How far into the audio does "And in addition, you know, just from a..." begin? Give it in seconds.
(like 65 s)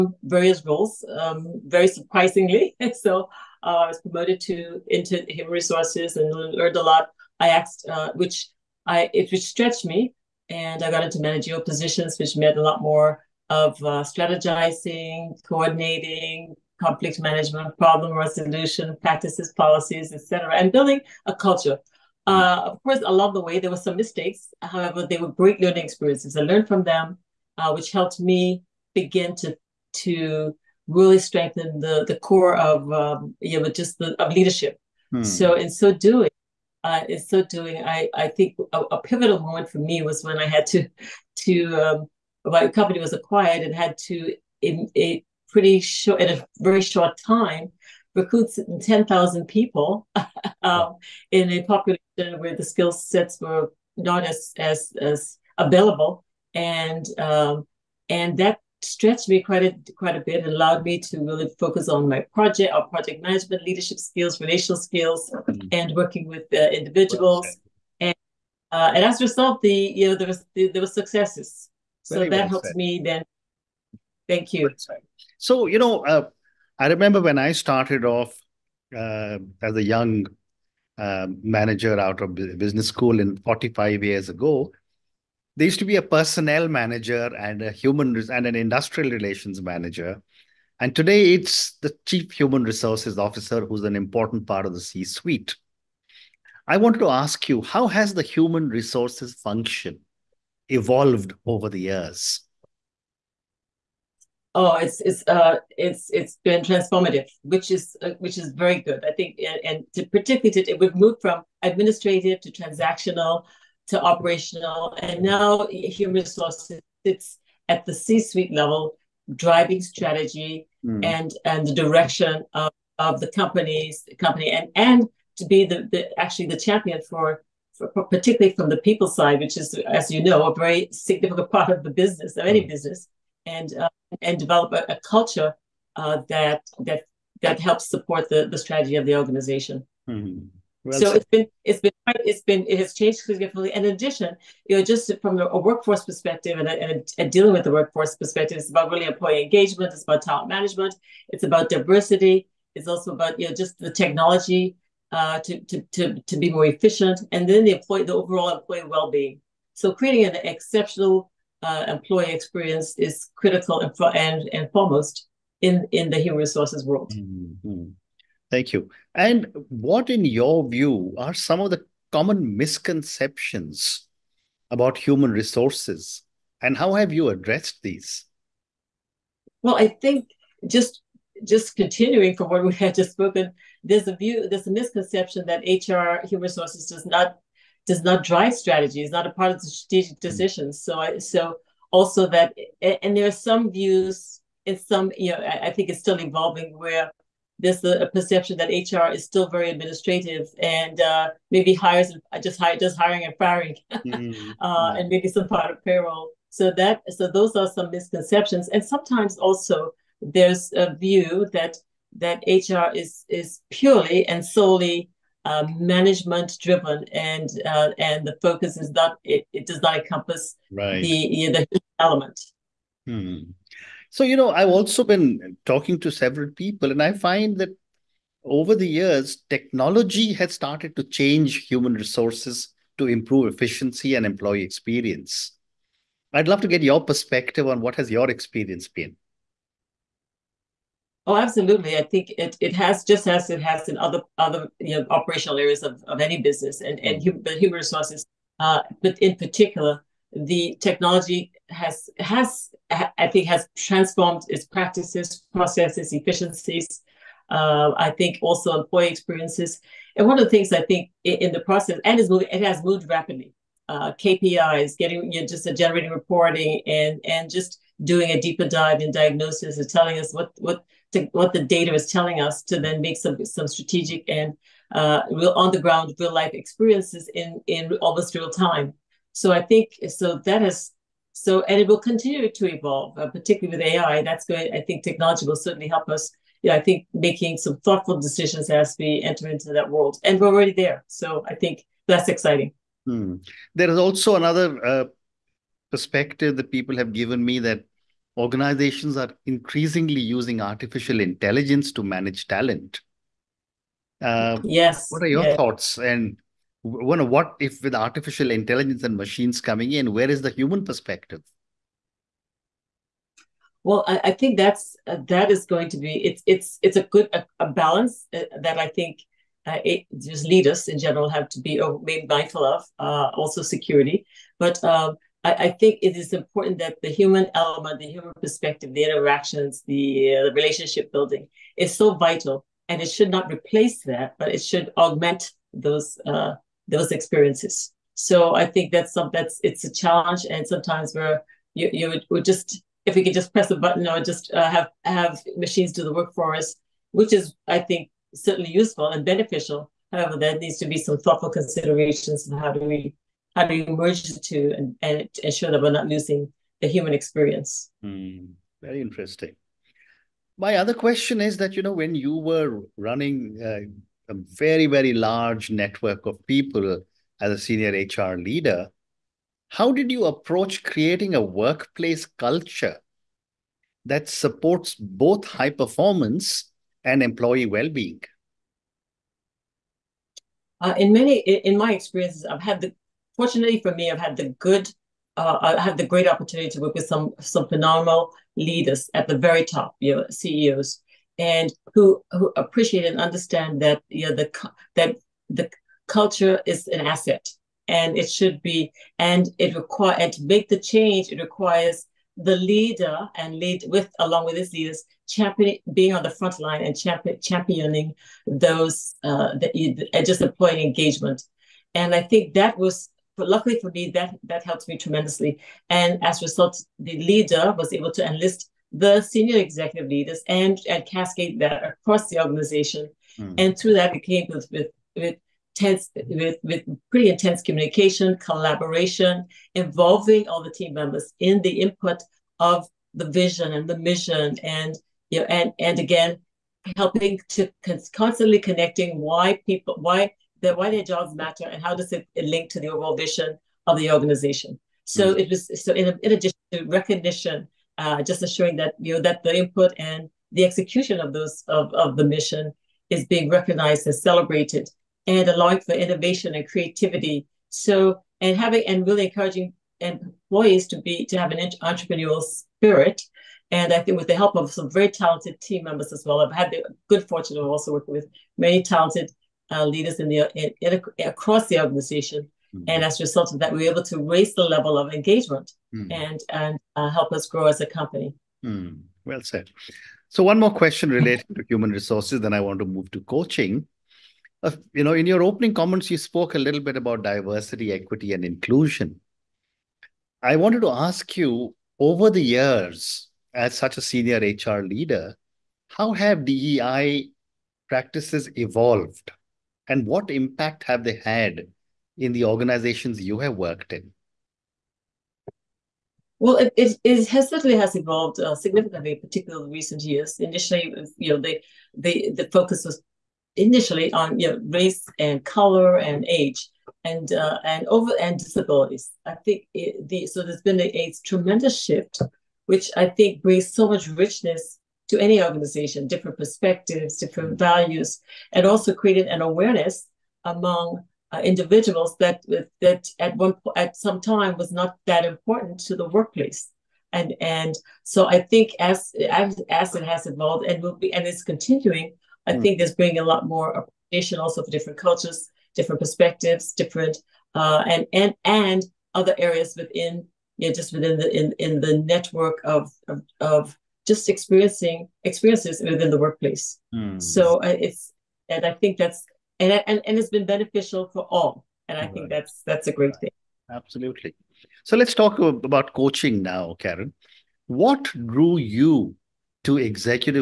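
143 s.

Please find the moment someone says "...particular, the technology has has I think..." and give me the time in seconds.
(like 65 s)
249 s.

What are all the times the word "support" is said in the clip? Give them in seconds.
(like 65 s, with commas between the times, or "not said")
137 s, 374 s.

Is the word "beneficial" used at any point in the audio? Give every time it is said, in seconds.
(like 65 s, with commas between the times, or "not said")
349 s, 560 s.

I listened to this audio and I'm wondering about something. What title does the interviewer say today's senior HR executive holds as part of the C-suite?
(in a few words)
chief human resources officer.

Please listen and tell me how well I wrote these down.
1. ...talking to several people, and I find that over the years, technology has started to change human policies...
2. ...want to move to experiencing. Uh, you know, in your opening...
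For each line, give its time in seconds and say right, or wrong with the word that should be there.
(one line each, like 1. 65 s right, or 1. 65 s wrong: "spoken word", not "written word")
1. 225 s wrong: "resources", not "policies"
2. 482 s wrong: "coaching", not "experiencing".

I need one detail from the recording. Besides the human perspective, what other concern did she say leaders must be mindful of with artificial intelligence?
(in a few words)
security.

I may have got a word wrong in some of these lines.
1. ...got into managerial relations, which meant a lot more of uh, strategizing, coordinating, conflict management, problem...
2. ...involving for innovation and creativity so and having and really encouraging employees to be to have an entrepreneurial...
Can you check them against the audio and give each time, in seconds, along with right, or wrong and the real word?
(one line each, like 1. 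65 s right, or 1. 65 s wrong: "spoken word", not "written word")
1. 10 s wrong: "positions", not "relations"
2. 455 s wrong: "allowing", not "involving".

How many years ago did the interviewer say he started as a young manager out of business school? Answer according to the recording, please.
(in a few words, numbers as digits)
45.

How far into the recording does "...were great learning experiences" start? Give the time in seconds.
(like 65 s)
25 s.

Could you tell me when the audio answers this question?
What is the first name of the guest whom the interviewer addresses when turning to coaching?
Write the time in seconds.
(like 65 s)
566 s.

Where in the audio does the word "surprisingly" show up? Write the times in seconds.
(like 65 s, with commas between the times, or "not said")
1 s.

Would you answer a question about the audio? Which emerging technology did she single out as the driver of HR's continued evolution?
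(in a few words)
AI.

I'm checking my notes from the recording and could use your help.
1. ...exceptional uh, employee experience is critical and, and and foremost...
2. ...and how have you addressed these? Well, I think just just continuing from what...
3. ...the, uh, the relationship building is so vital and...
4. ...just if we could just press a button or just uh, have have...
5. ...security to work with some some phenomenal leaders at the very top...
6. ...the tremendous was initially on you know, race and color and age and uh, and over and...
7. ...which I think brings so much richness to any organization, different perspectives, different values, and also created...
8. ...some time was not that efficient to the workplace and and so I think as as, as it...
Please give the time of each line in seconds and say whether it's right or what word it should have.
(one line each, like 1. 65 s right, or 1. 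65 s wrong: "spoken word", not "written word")
1. 160 s right
2. 176 s right
3. 329 s right
4. 342 s right
5. 386 s wrong: "opportunity", not "security"
6. 512 s wrong: "focus", not "tremendous"
7. 522 s right
8. 533 s wrong: "important", not "efficient".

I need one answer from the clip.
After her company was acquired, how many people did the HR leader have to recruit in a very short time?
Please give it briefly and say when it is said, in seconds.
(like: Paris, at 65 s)
10,000, at 48 s.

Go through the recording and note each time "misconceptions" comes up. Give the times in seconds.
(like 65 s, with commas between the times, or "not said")
172 s, 184 s, 207 s.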